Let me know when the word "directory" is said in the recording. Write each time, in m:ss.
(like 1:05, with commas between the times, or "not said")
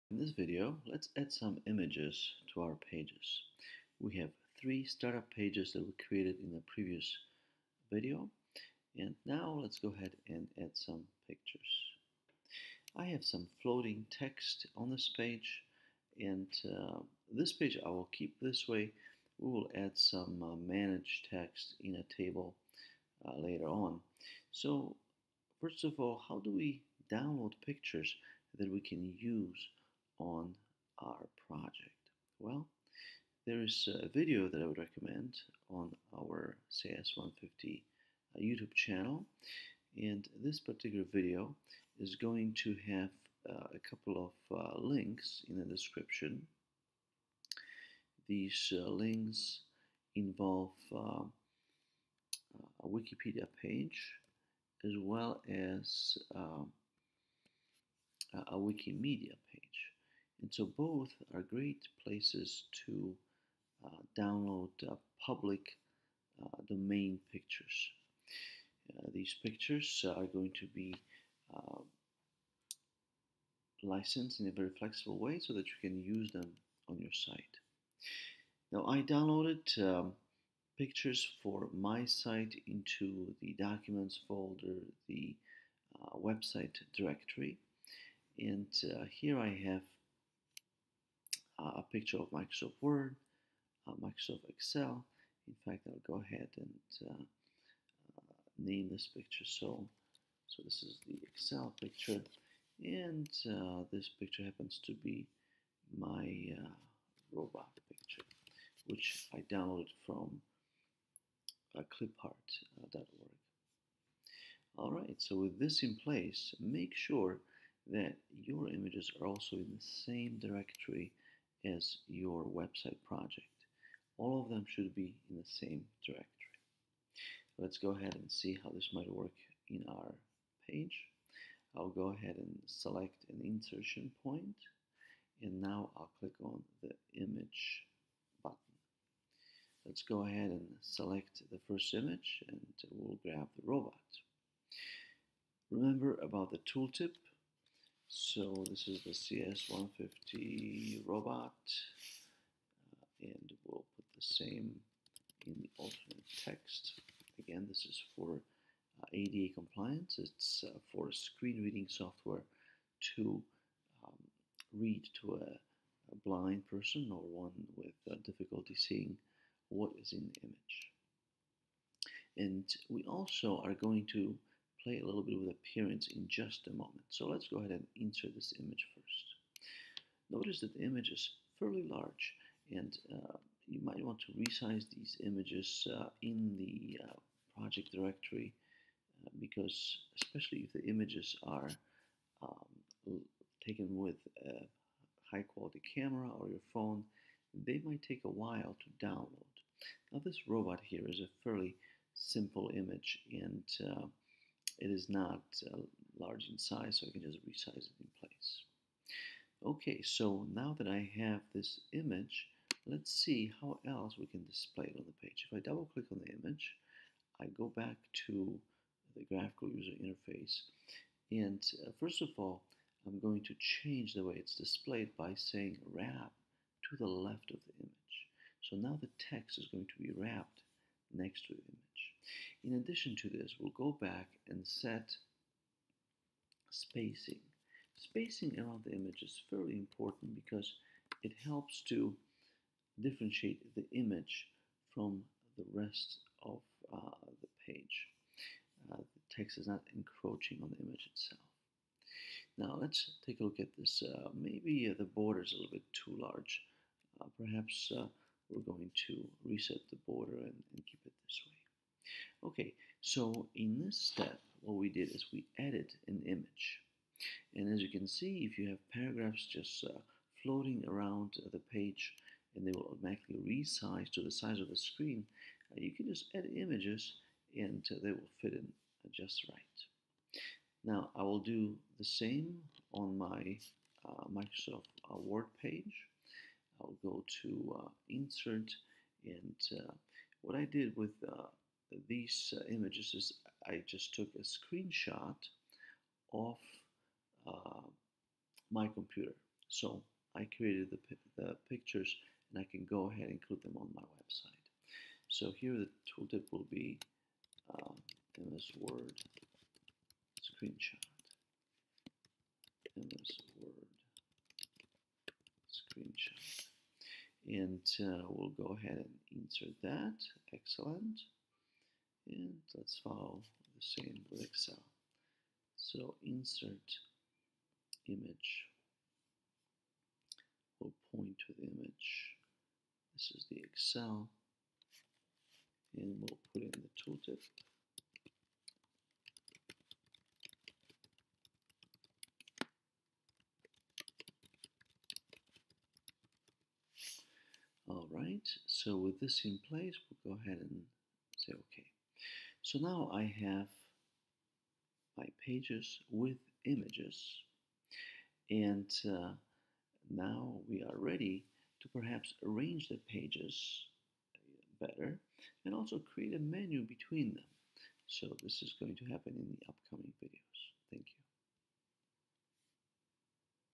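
1:26, 2:00, 2:06, 3:07.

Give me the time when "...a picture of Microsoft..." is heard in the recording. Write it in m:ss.
1:31.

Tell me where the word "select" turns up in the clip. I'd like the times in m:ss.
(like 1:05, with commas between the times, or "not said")
2:12, 2:20.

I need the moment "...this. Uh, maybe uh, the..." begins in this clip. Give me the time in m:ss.
4:13.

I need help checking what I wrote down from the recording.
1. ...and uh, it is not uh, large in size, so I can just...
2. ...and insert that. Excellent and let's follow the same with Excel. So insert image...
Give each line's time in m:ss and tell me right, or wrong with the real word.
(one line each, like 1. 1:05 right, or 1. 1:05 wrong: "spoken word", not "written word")
1. 3:23 right
2. 5:18 right.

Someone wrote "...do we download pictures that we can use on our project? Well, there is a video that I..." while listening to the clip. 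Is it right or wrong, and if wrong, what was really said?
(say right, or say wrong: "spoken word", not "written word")
right.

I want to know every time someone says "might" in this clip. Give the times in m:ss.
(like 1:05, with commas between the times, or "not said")
2:08, 3:03, 3:17.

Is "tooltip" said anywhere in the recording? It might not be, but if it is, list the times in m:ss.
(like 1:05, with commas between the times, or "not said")
2:26, 5:06, 5:37.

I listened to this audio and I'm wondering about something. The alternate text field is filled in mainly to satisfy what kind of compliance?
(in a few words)
ADA compliance.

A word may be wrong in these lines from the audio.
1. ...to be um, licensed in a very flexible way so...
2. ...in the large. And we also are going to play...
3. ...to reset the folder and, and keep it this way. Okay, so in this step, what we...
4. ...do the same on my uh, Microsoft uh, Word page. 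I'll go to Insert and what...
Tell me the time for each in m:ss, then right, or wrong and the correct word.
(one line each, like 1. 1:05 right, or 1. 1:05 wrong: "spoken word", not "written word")
1. 1:10 right
2. 2:50 wrong: "image", not "large"
3. 4:19 wrong: "border", not "folder"
4. 4:41 right.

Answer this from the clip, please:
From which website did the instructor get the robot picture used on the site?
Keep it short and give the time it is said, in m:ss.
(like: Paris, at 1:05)
clipart.org, at 1:51.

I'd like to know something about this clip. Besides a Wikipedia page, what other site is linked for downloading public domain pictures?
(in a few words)
Wikimedia.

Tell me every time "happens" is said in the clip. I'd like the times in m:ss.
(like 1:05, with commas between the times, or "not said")
1:44, 6:09.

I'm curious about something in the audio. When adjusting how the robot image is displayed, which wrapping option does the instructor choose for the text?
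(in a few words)
wrap to the left.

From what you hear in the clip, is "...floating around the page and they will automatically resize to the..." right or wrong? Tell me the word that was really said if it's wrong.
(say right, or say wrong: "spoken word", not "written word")
right.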